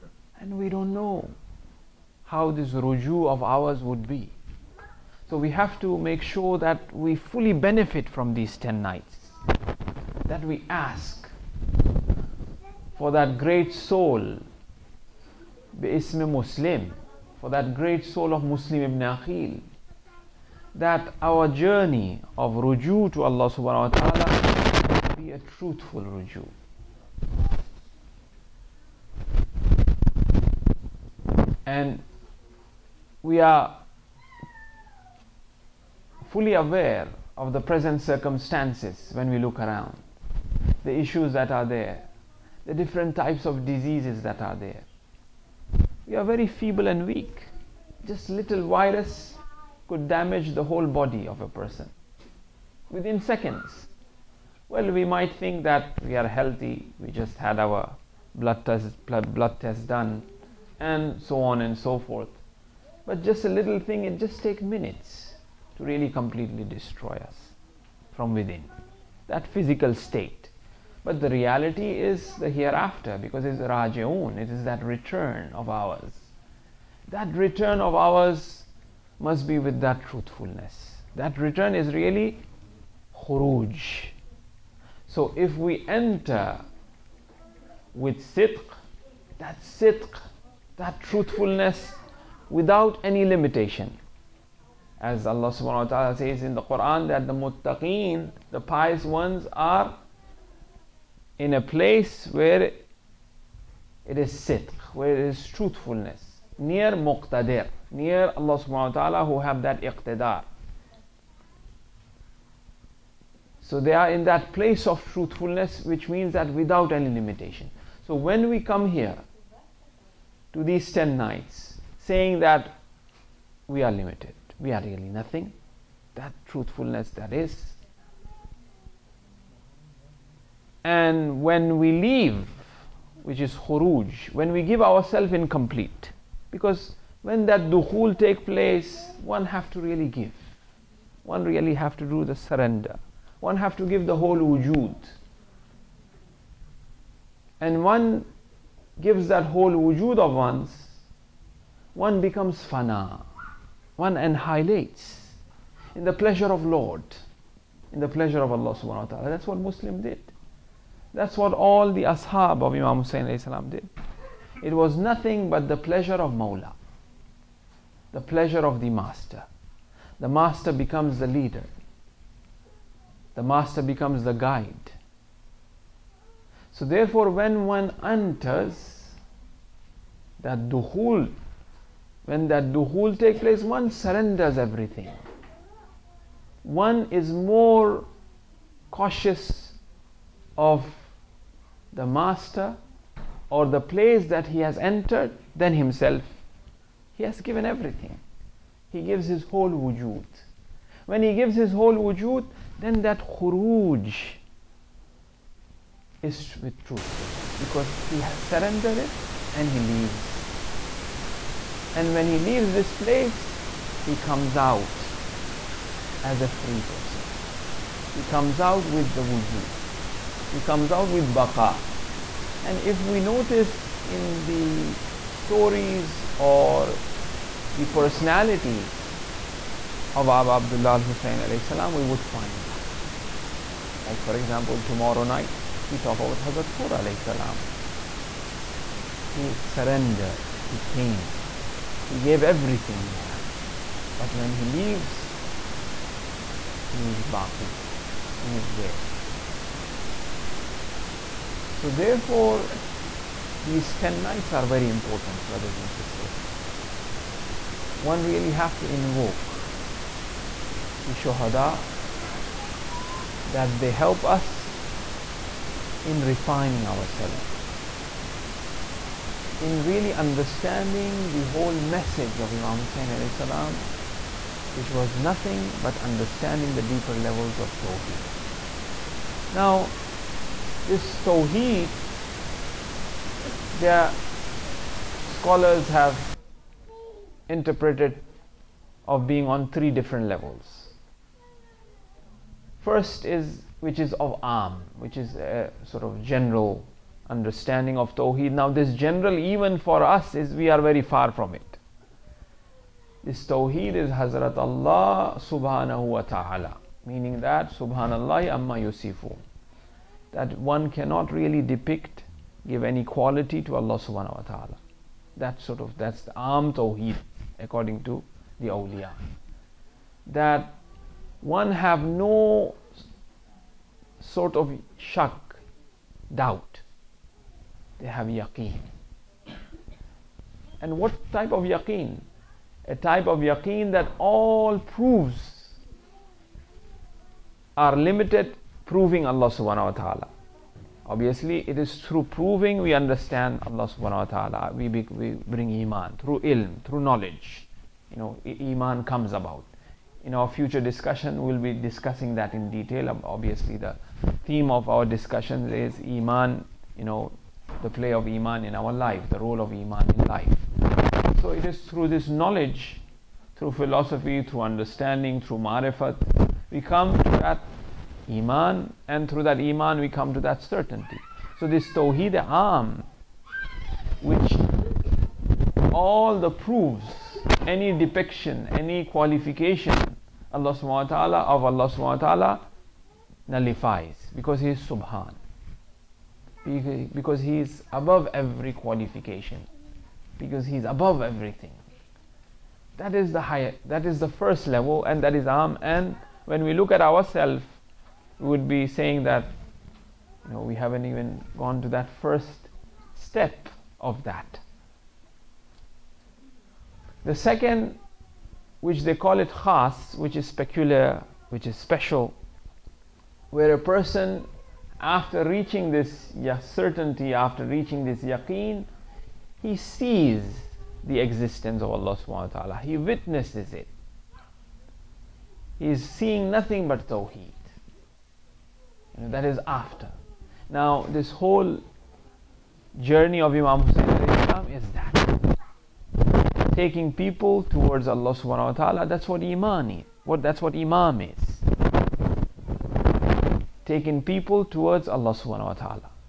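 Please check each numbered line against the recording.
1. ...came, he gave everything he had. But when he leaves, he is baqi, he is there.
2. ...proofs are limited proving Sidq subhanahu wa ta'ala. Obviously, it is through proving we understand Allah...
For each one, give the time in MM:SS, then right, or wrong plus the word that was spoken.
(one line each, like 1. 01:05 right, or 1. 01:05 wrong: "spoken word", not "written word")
1. 04:00 right
2. 05:34 wrong: "Allah", not "Sidq".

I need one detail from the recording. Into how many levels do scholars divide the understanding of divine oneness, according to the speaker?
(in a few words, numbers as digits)
3.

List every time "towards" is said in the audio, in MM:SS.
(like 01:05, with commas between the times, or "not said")
07:17, 07:24.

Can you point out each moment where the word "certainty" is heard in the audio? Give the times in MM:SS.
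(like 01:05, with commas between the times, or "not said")
06:10, 06:56.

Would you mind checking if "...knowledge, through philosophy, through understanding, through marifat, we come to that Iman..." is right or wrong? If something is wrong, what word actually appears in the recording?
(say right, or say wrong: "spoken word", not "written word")
right.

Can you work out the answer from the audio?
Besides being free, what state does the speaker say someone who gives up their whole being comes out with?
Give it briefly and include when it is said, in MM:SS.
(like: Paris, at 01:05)
baqa, at 03:41.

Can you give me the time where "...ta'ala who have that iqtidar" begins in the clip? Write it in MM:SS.
01:48.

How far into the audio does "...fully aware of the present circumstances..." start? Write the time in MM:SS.
00:36.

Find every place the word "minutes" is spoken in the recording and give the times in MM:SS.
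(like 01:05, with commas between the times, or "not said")
01:04.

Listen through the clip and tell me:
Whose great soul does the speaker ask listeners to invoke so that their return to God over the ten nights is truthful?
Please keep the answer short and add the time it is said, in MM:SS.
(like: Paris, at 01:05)
Muslim ibn Aqil, at 00:18.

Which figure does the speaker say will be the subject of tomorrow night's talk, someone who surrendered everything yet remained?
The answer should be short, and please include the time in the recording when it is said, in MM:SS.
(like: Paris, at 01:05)
Hurr, at 03:56.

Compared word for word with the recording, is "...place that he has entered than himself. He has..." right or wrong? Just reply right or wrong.
right.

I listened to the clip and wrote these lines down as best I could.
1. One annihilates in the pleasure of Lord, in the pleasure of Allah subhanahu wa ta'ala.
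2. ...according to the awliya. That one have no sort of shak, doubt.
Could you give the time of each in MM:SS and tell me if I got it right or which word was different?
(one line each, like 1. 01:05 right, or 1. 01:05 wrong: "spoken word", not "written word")
1. 02:33 right
2. 05:17 right.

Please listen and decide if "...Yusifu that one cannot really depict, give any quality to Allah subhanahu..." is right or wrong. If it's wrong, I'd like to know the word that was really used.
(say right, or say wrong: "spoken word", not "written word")
right.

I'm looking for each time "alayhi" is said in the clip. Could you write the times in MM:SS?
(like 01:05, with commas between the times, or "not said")
03:51, 03:57.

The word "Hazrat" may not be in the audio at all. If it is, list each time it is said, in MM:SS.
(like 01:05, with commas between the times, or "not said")
03:56, 05:04.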